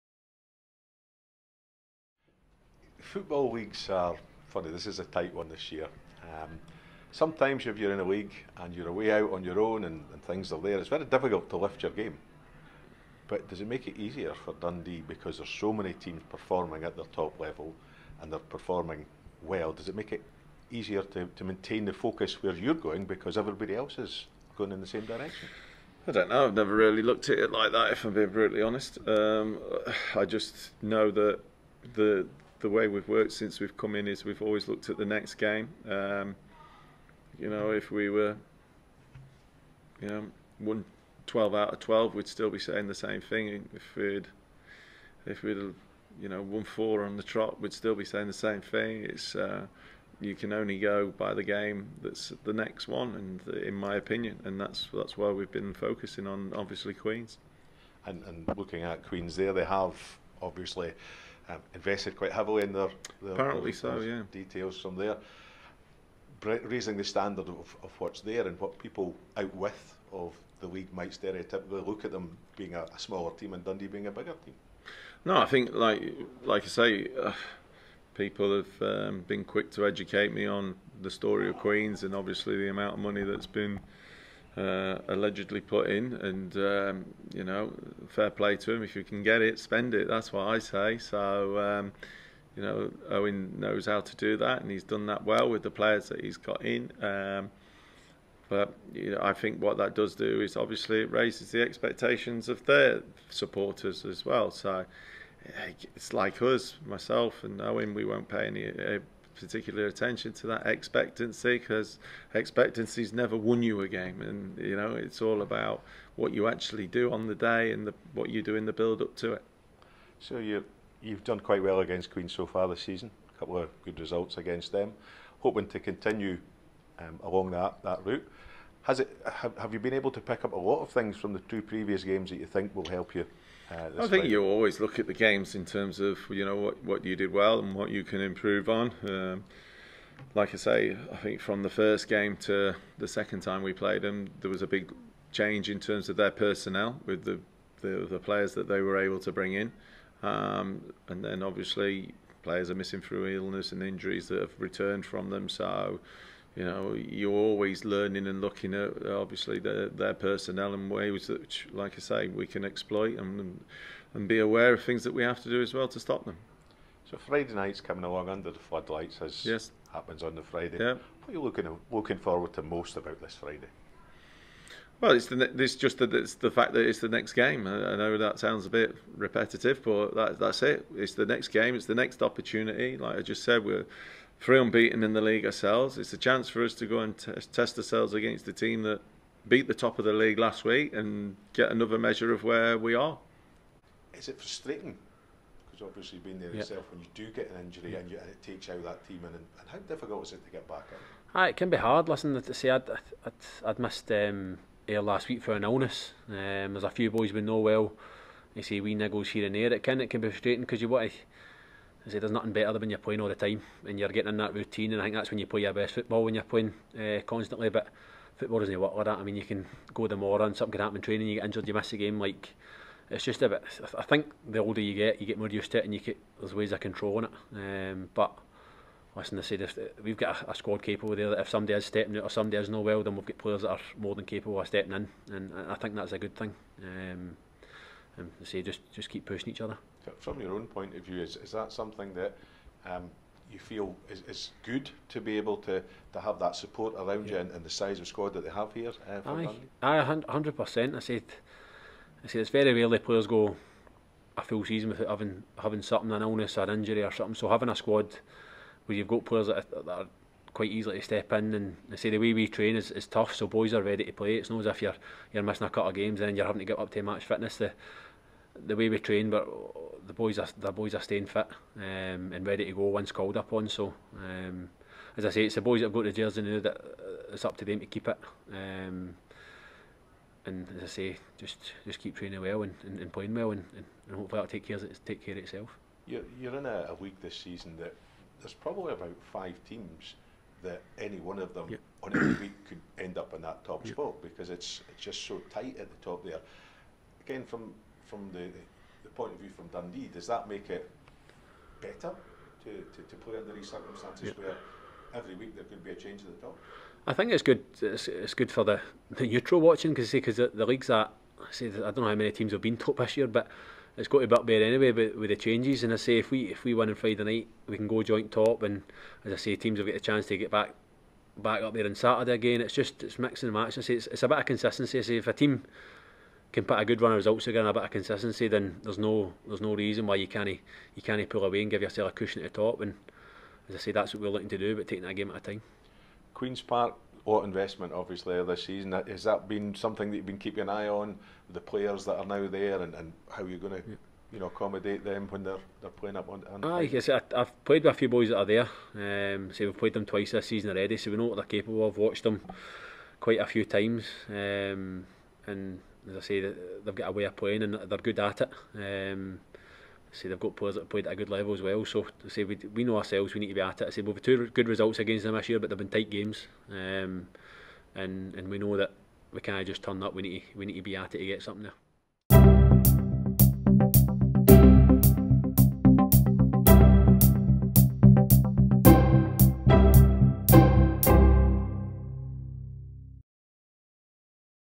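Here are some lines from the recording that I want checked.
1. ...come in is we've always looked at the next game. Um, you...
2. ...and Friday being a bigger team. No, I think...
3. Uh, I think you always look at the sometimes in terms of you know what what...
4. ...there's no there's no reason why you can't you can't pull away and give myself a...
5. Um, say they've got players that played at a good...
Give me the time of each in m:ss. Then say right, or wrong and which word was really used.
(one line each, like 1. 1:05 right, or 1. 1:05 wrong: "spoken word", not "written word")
1. 0:33 right
2. 1:13 wrong: "Dundee", not "Friday"
3. 2:13 wrong: "games", not "sometimes"
4. 5:28 wrong: "yourself", not "myself"
5. 5:58 right.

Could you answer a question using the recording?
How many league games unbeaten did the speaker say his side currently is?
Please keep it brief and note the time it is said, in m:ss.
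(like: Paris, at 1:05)
3, at 3:04.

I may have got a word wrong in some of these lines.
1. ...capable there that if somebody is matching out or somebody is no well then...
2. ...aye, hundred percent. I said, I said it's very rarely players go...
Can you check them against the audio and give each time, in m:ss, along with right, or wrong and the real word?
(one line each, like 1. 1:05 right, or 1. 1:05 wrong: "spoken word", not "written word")
1. 3:50 wrong: "stepping", not "matching"
2. 4:09 right.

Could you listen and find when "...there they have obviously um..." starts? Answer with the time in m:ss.
0:59.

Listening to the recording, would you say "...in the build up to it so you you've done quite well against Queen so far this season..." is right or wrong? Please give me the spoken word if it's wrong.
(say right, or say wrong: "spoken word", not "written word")
right.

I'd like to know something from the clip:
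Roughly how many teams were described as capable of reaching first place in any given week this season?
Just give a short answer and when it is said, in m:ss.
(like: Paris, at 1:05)
5, at 4:49.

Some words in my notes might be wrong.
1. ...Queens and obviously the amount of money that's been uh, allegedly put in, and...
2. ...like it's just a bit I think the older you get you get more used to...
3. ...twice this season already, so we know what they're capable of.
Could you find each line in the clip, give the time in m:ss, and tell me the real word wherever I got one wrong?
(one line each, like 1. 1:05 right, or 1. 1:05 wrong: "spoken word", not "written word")
1. 1:21 right
2. 3:42 right
3. 5:50 right.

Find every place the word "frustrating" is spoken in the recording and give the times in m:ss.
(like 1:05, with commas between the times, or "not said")
3:14, 3:30.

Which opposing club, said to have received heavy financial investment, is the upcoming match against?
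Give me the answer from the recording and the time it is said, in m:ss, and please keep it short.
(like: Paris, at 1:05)
Queens Park, at 5:36.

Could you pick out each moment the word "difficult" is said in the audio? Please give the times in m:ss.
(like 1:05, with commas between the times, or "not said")
0:11, 3:19.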